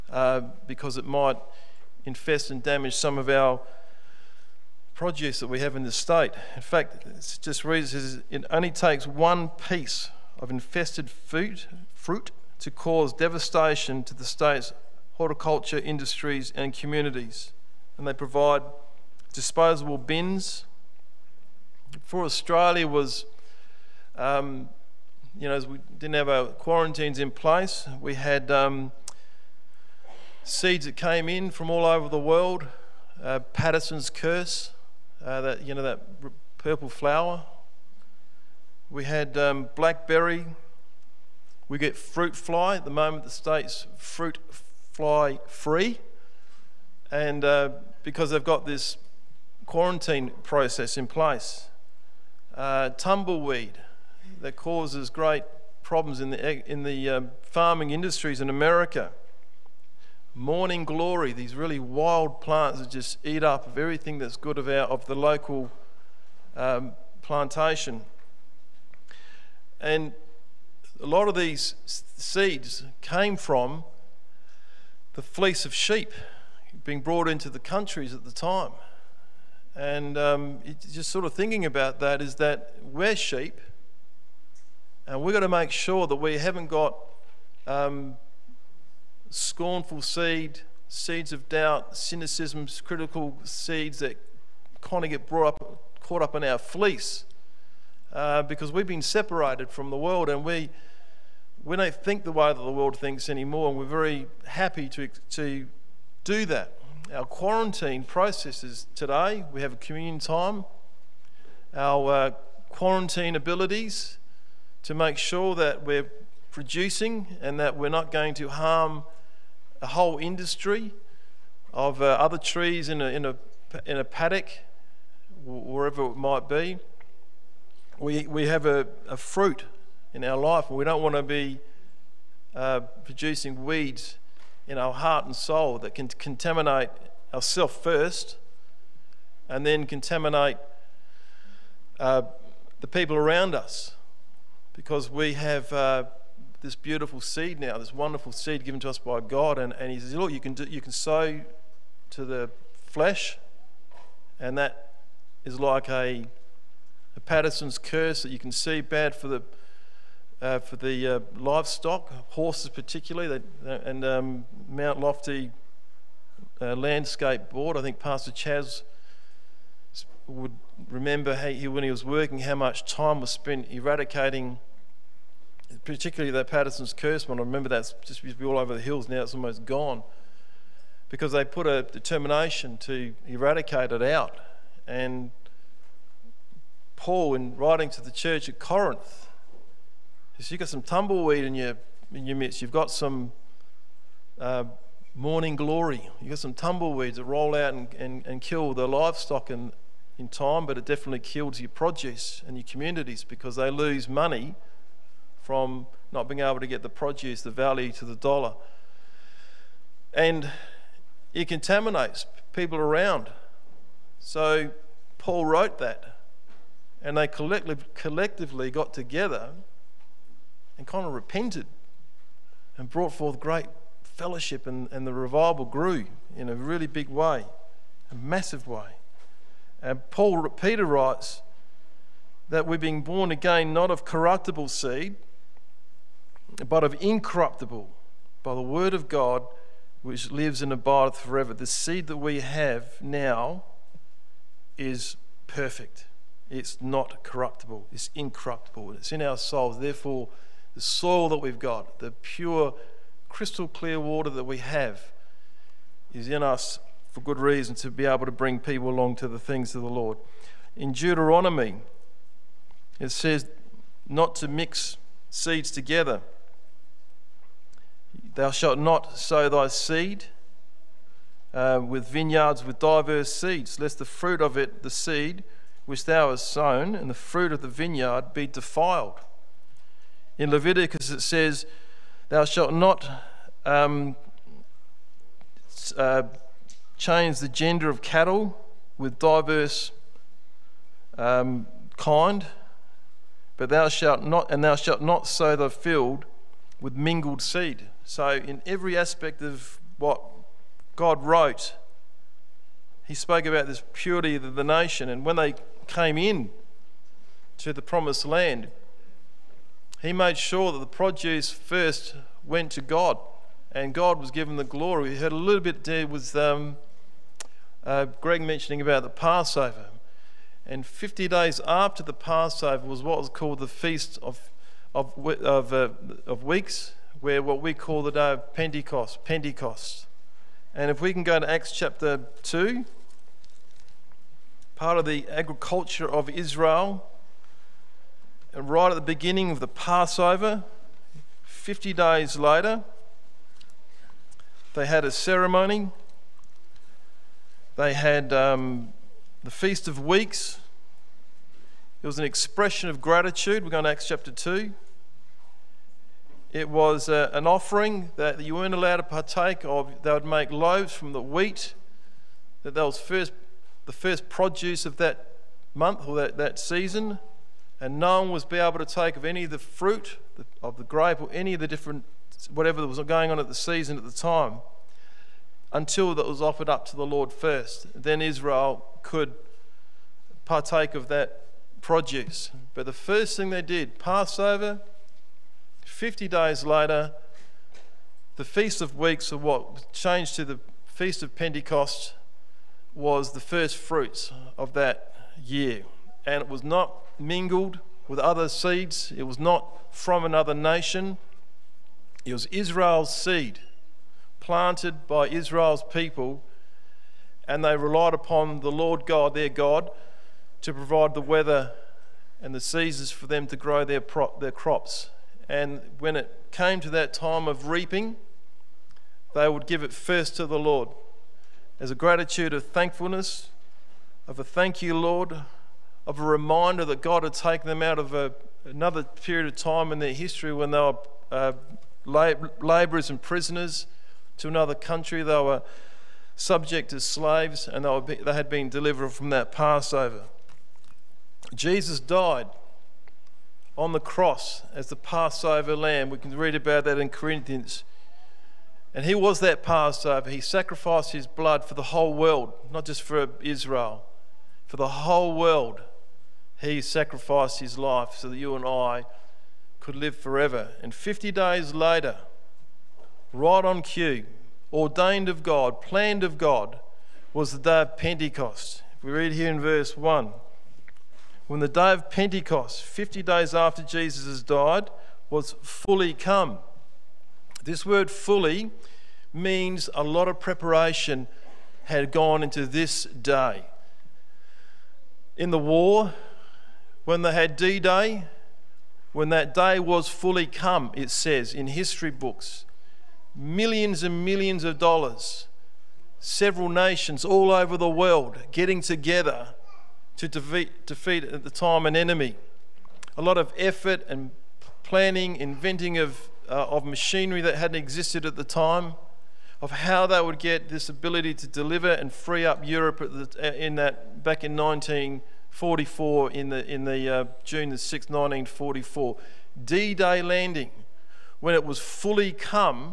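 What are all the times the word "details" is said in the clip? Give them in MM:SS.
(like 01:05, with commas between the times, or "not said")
not said.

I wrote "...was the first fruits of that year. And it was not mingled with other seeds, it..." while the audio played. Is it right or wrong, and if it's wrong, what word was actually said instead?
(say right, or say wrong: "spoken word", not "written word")
right.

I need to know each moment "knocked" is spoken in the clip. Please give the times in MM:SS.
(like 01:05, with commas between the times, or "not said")
not said.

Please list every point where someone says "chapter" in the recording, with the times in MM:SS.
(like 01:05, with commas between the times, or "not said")
05:31, 05:54.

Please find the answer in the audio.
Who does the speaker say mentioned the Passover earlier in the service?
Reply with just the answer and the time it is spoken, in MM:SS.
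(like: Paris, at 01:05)
Greg, at 05:18.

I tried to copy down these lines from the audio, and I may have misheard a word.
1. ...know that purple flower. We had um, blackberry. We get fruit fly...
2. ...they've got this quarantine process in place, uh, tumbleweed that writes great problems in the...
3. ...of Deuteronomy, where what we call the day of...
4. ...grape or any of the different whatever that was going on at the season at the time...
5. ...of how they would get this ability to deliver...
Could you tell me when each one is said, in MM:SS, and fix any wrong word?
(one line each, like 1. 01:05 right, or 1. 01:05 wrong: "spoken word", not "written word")
1. 00:35 right
2. 00:48 wrong: "causes", not "writes"
3. 05:26 wrong: "Weeks", not "Deuteronomy"
4. 06:10 right
5. 08:29 right.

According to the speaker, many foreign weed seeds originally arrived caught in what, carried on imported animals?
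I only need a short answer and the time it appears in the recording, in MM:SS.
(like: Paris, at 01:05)
Fleece of sheep, at 01:15.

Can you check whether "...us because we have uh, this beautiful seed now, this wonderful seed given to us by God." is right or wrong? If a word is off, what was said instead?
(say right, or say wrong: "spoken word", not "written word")
right.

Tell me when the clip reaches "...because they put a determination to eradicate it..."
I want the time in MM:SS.
03:01.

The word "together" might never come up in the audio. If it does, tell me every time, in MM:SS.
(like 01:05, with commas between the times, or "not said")
03:38, 04:25, 08:18.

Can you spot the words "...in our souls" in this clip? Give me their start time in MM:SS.
04:09.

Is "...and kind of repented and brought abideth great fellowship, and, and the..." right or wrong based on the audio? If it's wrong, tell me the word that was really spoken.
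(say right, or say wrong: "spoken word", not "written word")
wrong: "forth", not "abideth".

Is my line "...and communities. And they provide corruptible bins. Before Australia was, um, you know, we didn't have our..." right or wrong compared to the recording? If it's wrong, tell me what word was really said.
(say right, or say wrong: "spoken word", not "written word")
wrong: "disposable", not "corruptible".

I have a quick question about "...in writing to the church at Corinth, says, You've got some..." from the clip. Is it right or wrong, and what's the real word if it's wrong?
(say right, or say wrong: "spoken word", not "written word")
right.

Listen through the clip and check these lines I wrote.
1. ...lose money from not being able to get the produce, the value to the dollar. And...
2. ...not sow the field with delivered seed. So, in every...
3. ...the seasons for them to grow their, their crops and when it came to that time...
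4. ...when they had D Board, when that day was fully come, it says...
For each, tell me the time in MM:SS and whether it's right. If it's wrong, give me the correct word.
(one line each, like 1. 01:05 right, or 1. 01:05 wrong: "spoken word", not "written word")
1. 03:23 right
2. 04:55 wrong: "mingled", not "delivered"
3. 06:52 right
4. 08:07 wrong: "Day", not "Board".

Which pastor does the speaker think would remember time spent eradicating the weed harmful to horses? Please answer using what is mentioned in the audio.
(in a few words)
Pastor Chaz.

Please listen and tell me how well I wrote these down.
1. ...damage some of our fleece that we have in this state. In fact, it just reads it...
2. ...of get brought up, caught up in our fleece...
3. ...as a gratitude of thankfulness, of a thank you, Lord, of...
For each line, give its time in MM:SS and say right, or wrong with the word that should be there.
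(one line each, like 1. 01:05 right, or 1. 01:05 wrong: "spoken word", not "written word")
1. 00:02 wrong: "produce", not "fleece"
2. 01:35 right
3. 07:01 right.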